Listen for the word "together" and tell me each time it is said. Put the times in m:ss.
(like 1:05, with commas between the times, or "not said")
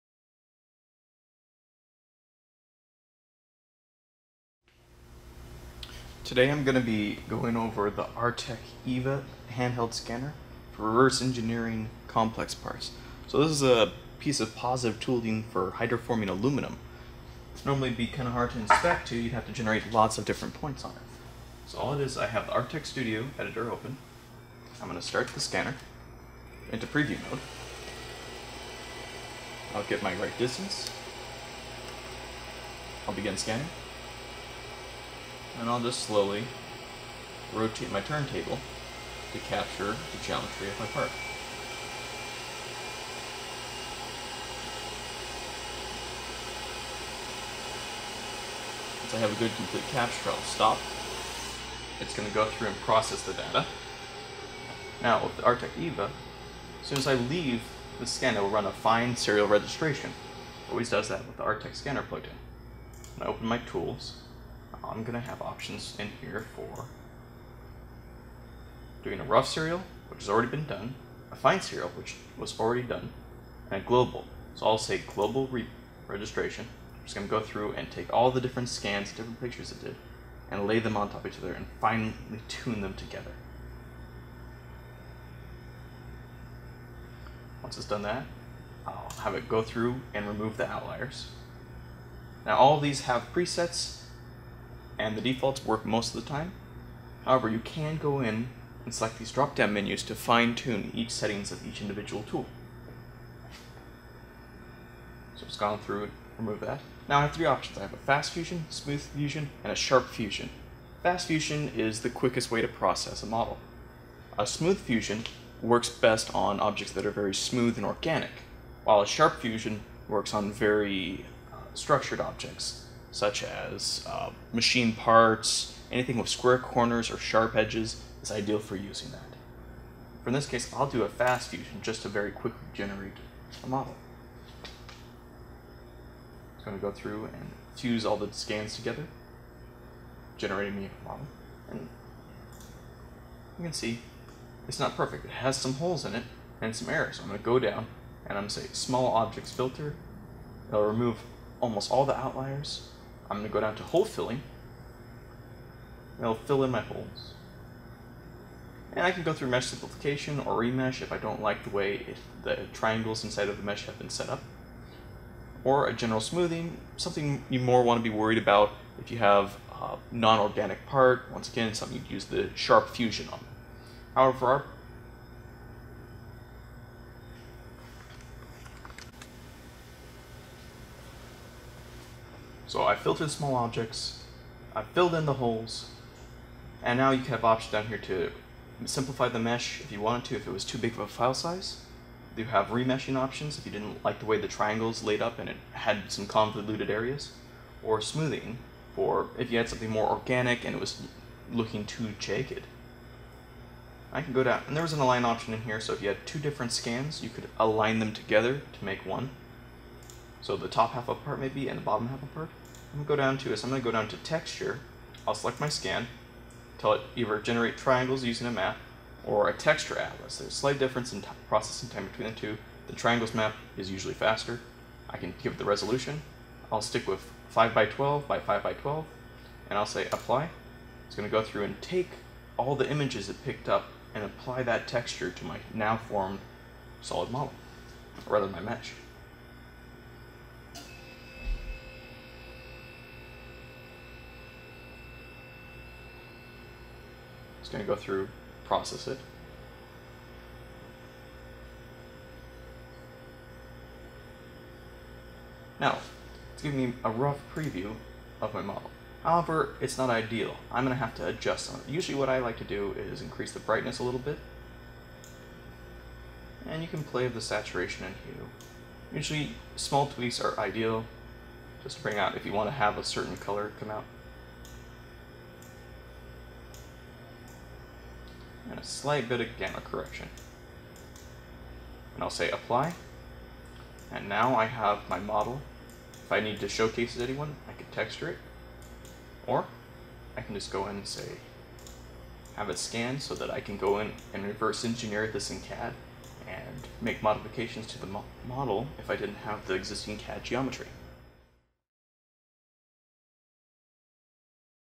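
1:22, 2:18, 3:28.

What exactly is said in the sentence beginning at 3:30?
So the top half of a part maybe and the bottom half of a part.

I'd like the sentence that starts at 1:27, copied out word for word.
Once it's done that, I'll have it go through and remove the outliers.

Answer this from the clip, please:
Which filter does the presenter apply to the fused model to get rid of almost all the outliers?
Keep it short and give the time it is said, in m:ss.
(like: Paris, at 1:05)
small objects filter, at 2:28.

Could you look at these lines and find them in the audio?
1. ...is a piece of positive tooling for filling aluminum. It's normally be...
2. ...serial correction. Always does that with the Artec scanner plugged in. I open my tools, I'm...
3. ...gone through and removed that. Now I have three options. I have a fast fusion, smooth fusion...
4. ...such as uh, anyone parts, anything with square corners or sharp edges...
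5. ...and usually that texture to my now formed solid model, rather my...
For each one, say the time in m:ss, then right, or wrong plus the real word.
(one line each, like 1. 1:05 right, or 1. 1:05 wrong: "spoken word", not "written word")
1. 0:13 wrong: "hydroforming", not "filling"
2. 0:59 wrong: "registration", not "correction"
3. 1:45 right
4. 2:03 wrong: "machine", not "anyone"
5. 3:54 wrong: "apply", not "usually".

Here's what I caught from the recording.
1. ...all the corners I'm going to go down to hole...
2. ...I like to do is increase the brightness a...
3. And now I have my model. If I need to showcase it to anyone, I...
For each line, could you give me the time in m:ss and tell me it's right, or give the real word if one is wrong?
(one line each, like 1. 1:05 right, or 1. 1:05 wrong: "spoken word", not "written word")
1. 2:31 wrong: "outliers", not "corners"
2. 4:22 right
3. 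4:44 right.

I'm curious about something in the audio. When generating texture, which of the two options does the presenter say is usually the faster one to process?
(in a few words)
triangles map.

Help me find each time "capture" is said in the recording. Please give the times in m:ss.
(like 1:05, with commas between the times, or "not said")
0:39, 0:49.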